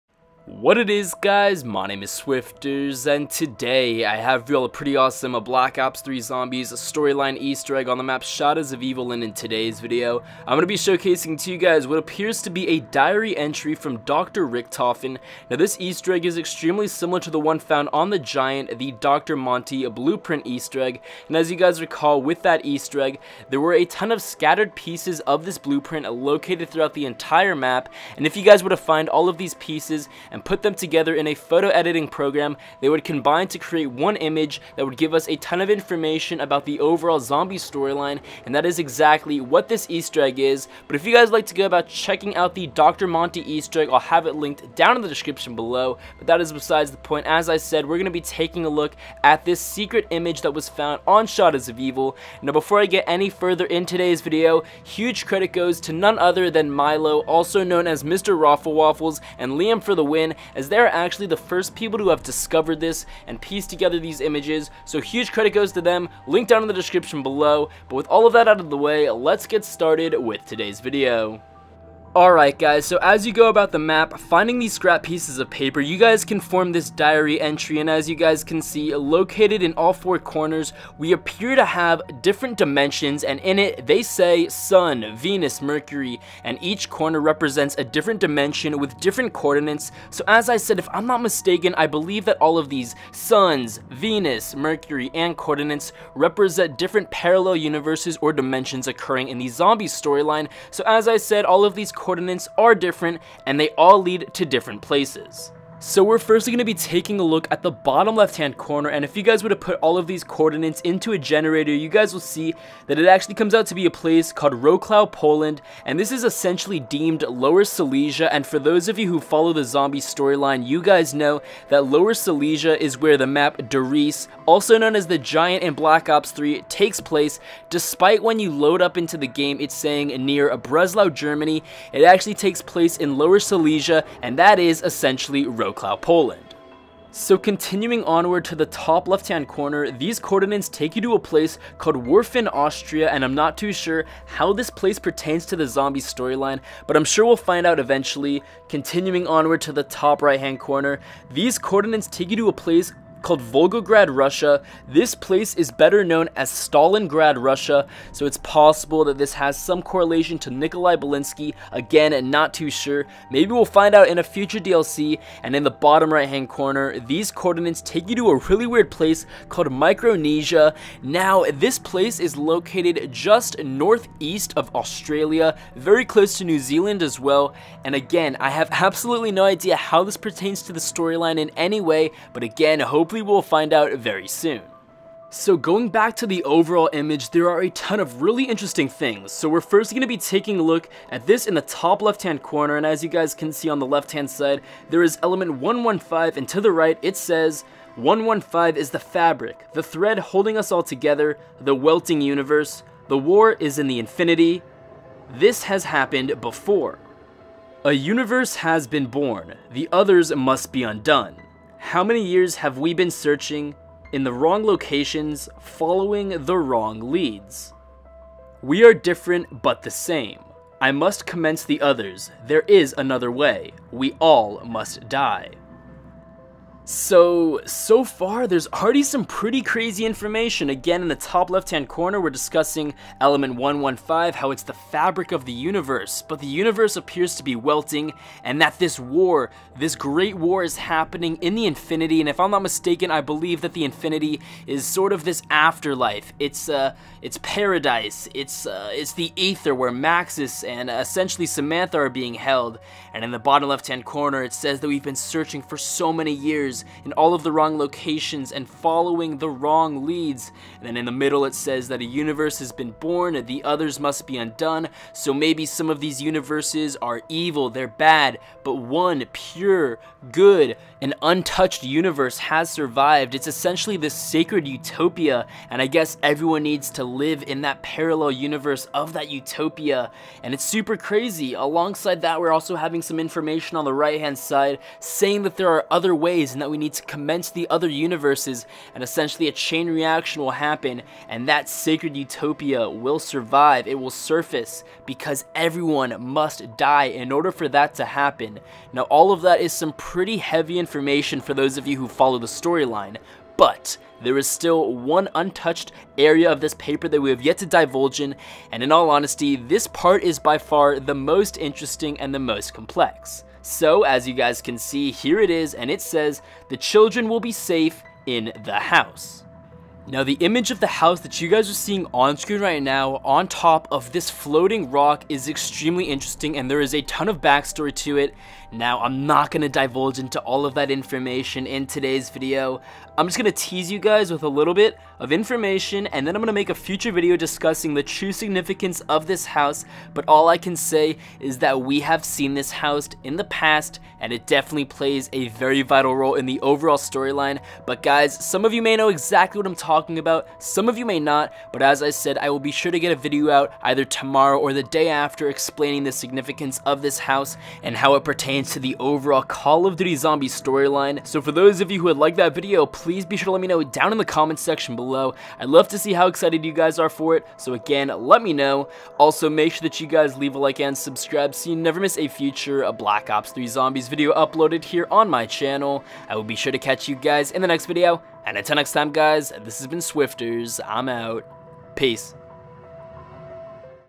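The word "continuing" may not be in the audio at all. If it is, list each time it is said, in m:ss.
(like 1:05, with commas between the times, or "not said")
2:17, 2:28.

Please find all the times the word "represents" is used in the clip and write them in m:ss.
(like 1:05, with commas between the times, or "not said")
1:27, 1:36.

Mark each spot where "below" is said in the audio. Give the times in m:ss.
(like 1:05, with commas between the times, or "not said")
0:45, 1:07, 6:04.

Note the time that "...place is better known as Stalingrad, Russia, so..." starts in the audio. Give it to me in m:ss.
2:35.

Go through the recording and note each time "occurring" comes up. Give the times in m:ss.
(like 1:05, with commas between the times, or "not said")
1:38.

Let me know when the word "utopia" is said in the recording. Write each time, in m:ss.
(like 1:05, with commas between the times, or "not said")
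4:34, 4:39, 4:52.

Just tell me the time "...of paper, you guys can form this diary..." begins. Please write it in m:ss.
1:15.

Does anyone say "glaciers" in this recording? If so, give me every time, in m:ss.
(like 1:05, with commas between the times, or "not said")
not said.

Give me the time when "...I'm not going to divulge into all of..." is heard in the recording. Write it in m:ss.
5:29.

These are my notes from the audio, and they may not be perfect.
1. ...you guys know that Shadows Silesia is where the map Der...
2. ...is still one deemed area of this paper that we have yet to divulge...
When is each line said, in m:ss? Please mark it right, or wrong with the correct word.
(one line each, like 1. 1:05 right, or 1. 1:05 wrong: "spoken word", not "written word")
1. 2:00 wrong: "Lower", not "Shadows"
2. 5:04 wrong: "untouched", not "deemed".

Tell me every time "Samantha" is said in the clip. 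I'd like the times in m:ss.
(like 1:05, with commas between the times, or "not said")
4:11.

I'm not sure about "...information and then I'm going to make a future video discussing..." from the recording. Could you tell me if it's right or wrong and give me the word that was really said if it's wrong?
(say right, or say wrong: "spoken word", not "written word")
right.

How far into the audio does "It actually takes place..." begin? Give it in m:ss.
2:11.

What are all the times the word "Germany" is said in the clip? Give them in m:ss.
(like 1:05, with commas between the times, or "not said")
2:11.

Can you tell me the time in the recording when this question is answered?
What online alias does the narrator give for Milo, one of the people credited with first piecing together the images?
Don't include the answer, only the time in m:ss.
0:58.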